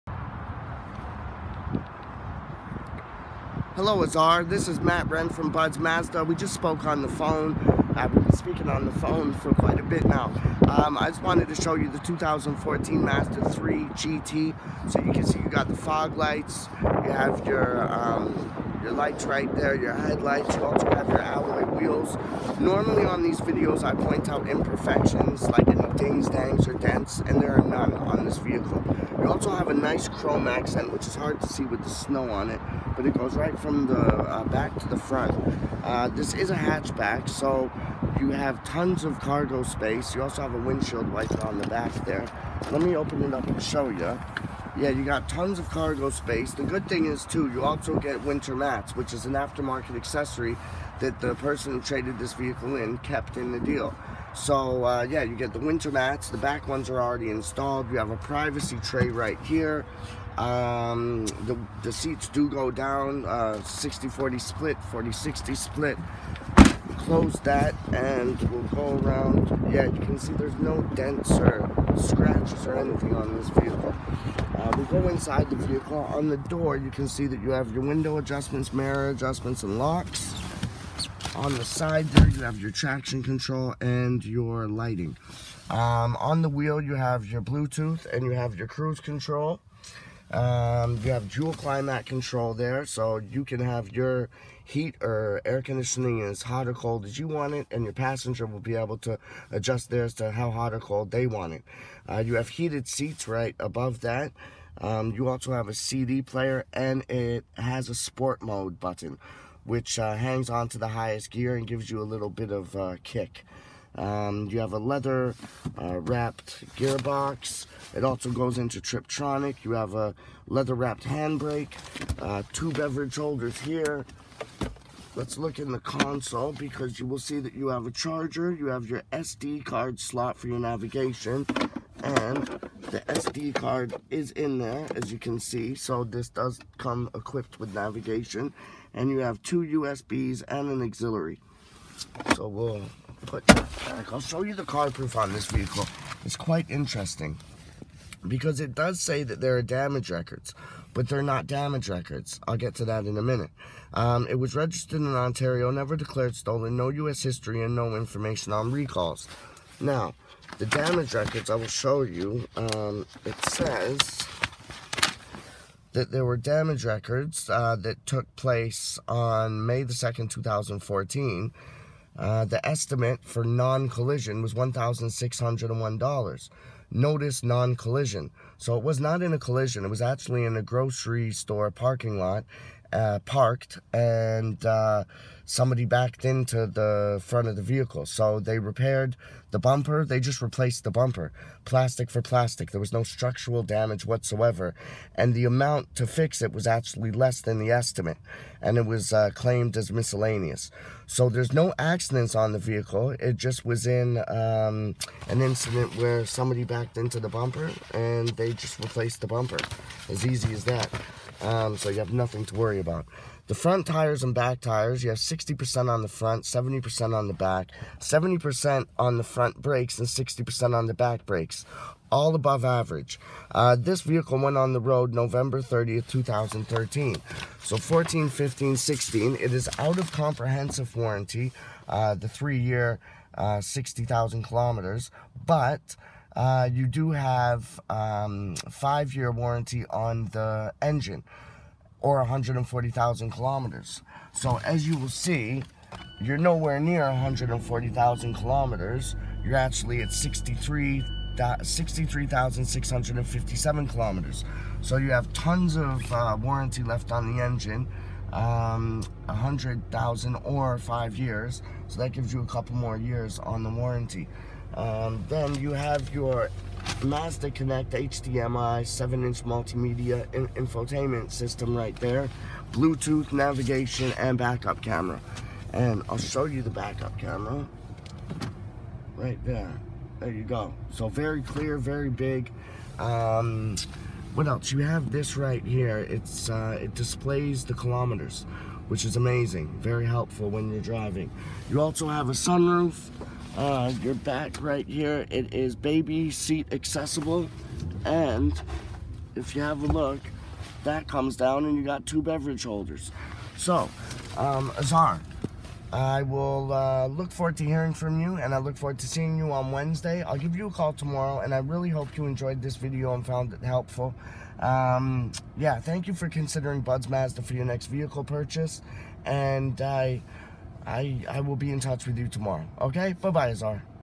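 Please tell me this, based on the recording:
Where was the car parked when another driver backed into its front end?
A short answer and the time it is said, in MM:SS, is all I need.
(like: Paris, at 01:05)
grocery store parking lot, at 03:00.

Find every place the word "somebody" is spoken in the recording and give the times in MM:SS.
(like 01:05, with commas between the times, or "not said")
03:05, 03:26.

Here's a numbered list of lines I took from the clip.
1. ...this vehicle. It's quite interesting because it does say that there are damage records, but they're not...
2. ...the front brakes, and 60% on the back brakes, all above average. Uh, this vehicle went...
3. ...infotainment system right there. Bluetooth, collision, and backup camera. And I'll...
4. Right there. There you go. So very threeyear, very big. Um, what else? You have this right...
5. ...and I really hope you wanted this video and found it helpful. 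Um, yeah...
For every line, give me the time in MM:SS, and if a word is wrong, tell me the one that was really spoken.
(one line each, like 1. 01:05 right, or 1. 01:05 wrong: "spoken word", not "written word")
1. 02:25 right
2. 03:39 right
3. 04:30 wrong: "navigation", not "collision"
4. 04:39 wrong: "clear", not "threeyear"
5. 05:11 wrong: "enjoyed", not "wanted".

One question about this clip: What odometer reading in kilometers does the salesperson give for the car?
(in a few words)
63,657.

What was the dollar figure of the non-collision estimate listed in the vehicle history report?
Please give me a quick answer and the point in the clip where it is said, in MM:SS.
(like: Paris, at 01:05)
$1,601, at 02:54.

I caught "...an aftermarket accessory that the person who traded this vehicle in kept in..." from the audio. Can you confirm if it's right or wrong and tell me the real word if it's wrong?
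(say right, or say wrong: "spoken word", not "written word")
right.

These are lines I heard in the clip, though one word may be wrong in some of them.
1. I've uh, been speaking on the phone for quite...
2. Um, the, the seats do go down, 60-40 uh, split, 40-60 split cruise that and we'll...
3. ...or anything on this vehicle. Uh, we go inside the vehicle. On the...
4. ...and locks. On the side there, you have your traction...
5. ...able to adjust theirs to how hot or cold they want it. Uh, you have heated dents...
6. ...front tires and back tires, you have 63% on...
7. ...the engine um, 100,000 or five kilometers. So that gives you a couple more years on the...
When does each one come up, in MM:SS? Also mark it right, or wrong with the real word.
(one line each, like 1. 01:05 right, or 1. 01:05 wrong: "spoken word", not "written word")
1. 00:07 right
2. 01:00 wrong: "close", not "cruise"
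3. 01:12 right
4. 01:19 right
5. 01:38 wrong: "seats", not "dents"
6. 03:33 wrong: "60", not "63"
7. 04:17 wrong: "years", not "kilometers".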